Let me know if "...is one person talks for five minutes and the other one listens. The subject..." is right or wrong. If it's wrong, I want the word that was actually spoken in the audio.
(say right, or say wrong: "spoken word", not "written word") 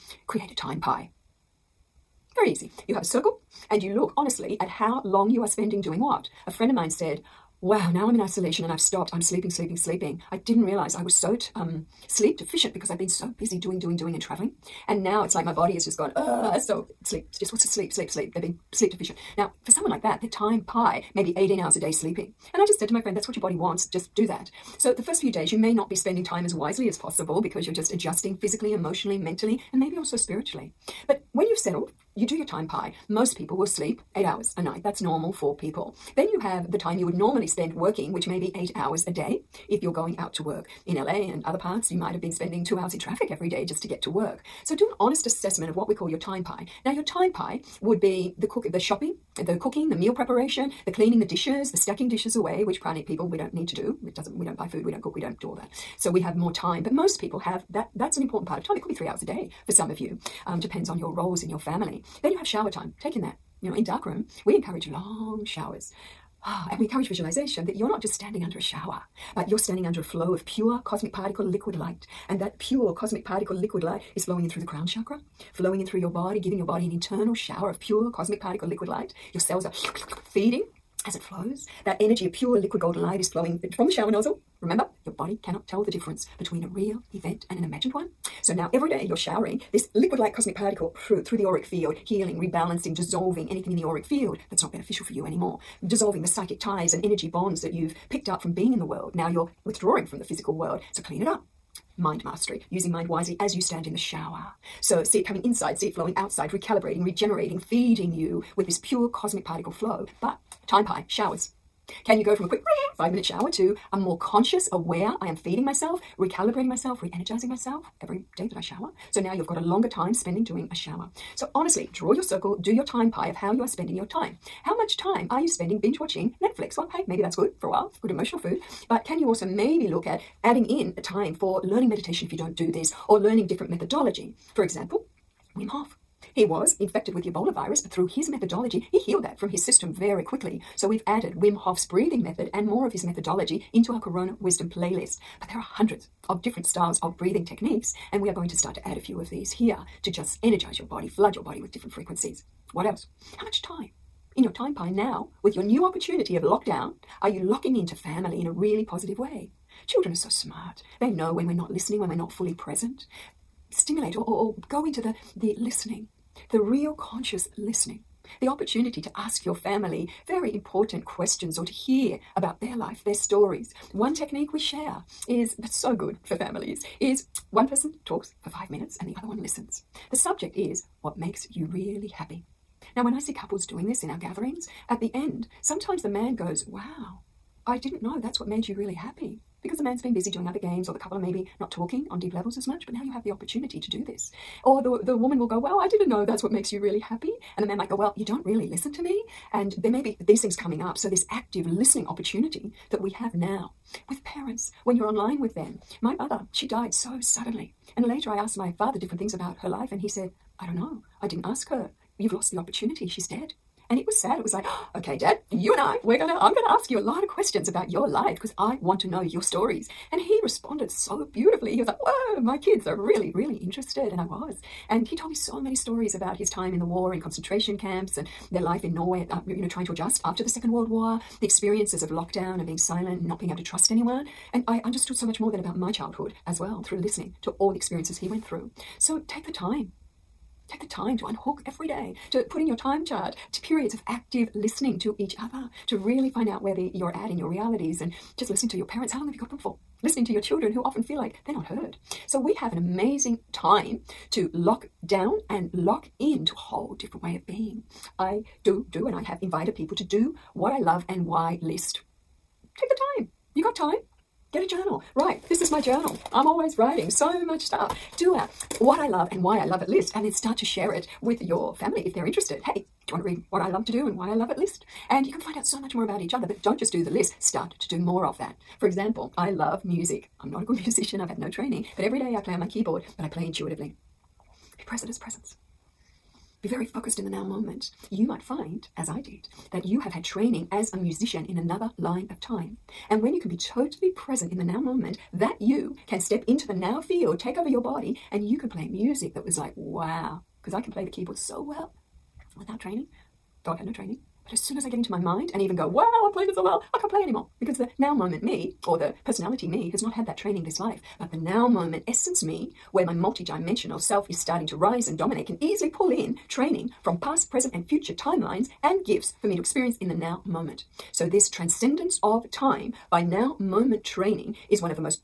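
right.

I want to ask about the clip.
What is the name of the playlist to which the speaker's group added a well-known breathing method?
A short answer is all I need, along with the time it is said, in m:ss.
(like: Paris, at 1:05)
Corona Wisdom, at 2:24.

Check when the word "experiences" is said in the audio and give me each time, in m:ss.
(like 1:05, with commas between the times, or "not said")
3:51, 3:57, 5:19.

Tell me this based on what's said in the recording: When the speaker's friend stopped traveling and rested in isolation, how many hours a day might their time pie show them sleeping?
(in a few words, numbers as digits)
18.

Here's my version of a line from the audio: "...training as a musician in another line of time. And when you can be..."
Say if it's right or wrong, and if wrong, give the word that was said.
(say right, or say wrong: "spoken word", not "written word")
right.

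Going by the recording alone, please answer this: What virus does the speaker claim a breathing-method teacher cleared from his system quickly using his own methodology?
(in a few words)
Ebola.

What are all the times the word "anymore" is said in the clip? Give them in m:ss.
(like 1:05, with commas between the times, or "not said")
1:35, 5:07.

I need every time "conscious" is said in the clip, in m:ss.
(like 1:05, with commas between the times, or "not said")
1:54, 2:46.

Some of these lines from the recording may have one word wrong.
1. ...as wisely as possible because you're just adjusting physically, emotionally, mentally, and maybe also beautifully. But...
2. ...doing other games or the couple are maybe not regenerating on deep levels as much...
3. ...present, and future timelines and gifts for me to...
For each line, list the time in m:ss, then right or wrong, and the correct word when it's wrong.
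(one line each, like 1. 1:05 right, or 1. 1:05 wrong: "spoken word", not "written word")
1. 0:26 wrong: "spiritually", not "beautifully"
2. 3:10 wrong: "talking", not "regenerating"
3. 5:17 right.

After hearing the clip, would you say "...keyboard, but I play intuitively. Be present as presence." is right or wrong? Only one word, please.
right.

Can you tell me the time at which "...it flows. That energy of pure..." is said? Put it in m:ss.
1:21.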